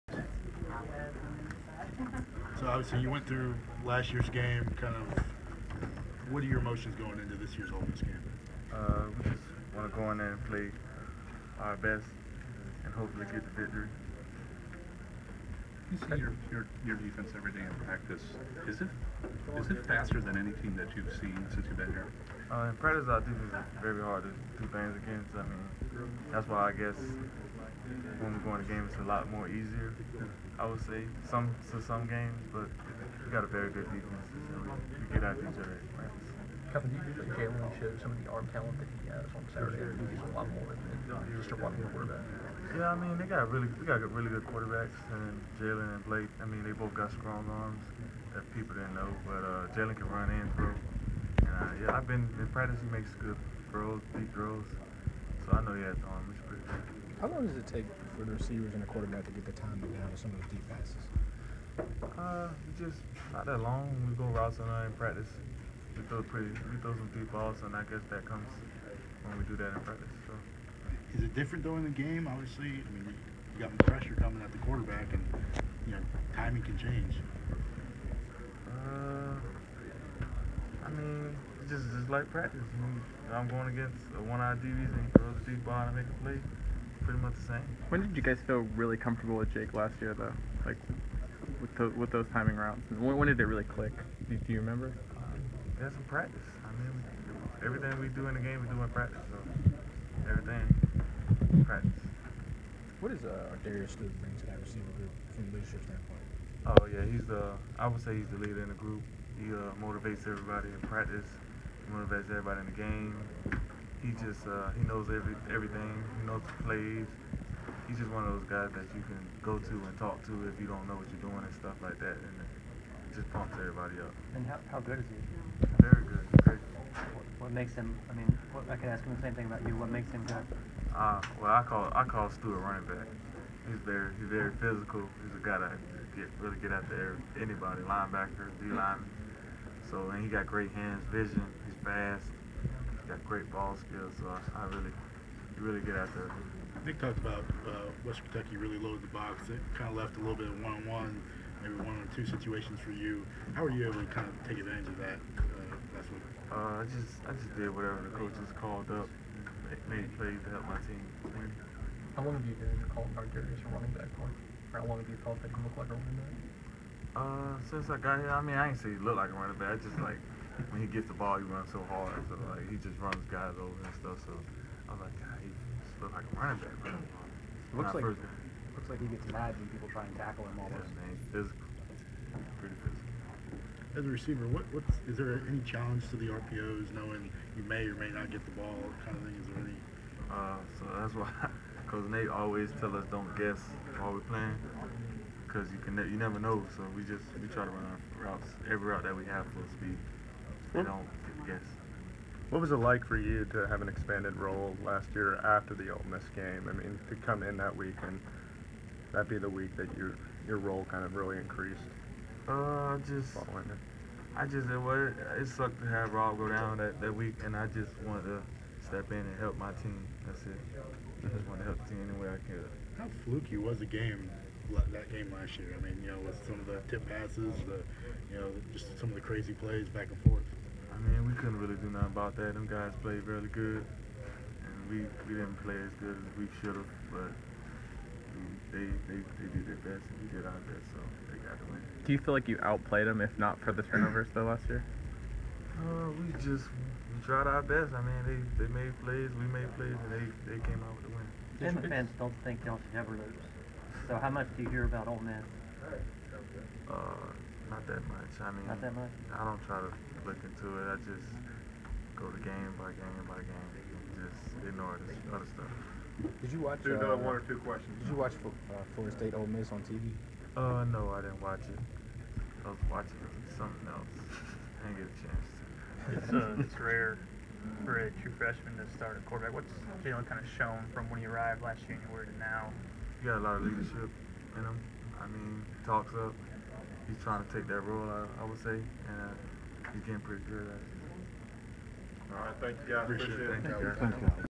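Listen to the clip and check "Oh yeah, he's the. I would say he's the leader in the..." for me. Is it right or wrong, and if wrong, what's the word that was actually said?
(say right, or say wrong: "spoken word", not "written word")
right.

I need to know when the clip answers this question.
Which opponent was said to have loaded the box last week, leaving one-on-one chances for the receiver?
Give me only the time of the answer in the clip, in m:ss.
2:28.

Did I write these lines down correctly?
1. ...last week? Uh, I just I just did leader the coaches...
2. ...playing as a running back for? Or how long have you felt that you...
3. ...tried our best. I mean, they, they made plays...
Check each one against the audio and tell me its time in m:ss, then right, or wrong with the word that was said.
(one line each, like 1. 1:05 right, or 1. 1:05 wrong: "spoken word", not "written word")
1. 2:35 wrong: "whatever", not "leader"
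2. 2:42 wrong: "calling", not "playing"
3. 4:07 right.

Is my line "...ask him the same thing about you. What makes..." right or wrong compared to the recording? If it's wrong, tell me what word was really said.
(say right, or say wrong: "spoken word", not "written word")
right.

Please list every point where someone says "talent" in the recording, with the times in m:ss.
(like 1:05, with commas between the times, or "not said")
0:38.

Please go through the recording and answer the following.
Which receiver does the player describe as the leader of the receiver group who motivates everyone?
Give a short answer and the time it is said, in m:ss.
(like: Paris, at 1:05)
Darius Stewart, at 1:43.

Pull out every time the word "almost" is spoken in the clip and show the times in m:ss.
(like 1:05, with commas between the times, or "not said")
3:00.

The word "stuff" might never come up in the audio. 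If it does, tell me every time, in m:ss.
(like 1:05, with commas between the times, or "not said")
2:01, 2:53, 4:25.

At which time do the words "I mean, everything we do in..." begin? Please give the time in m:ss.
1:36.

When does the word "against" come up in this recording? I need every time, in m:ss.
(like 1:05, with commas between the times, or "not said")
0:25, 1:23.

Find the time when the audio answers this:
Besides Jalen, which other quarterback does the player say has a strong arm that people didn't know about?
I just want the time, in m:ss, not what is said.
0:46.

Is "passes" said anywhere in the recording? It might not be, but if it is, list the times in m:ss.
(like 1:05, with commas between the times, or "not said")
1:00, 3:47.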